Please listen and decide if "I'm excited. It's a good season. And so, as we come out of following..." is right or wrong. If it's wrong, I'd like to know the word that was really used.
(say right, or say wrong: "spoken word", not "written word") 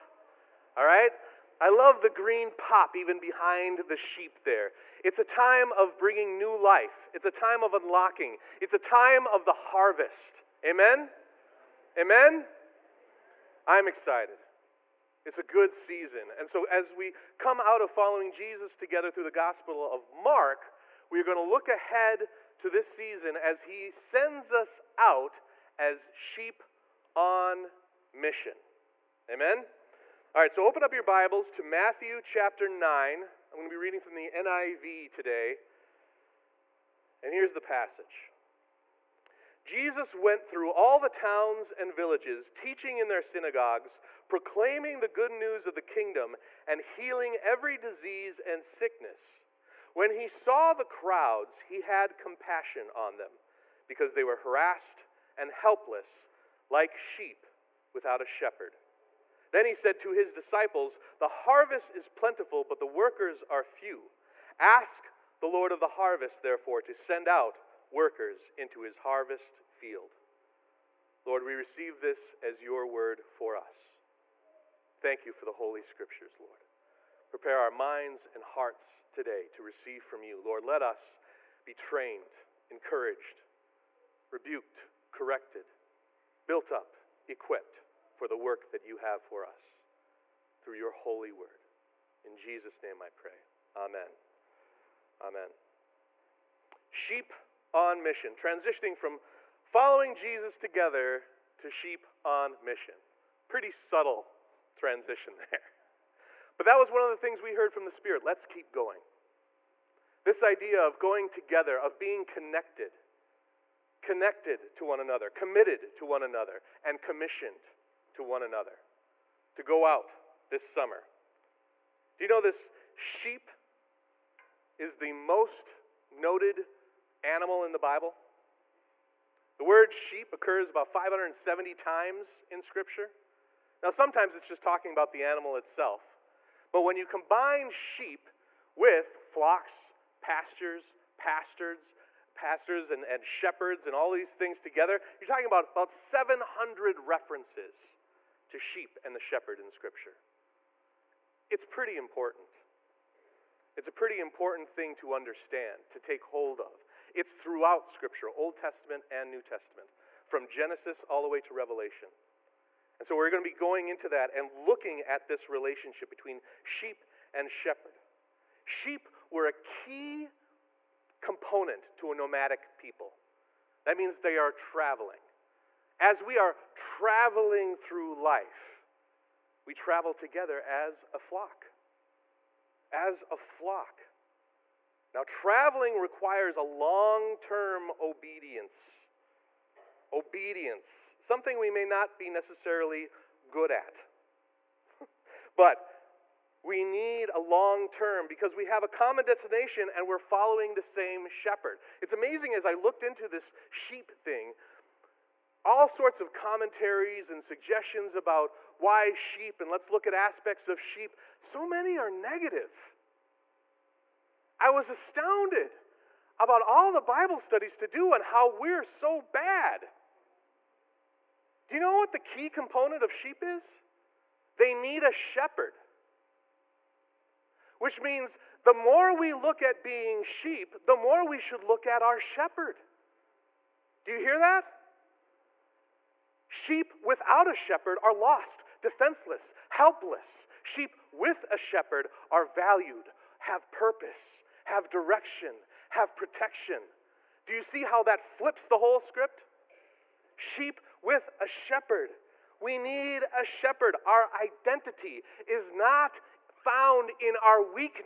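right.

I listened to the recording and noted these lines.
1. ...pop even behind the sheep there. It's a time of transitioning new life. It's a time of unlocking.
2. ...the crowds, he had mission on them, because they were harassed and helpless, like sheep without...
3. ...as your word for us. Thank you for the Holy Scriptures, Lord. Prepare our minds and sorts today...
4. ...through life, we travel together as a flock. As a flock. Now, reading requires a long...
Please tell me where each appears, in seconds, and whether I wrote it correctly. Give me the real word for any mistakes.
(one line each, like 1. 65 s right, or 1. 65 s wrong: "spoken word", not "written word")
1. 2 s wrong: "bringing", not "transitioning"
2. 50 s wrong: "compassion", not "mission"
3. 72 s wrong: "hearts", not "sorts"
4. 177 s wrong: "traveling", not "reading".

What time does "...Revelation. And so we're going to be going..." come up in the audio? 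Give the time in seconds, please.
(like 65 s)
161 s.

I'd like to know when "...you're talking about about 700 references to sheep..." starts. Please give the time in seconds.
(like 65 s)
145 s.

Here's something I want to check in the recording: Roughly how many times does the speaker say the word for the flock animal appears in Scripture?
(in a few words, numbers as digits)
570.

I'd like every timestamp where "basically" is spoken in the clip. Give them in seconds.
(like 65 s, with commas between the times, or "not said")
not said.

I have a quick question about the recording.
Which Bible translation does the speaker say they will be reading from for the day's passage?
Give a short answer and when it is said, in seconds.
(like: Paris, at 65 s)
NIV, at 34 s.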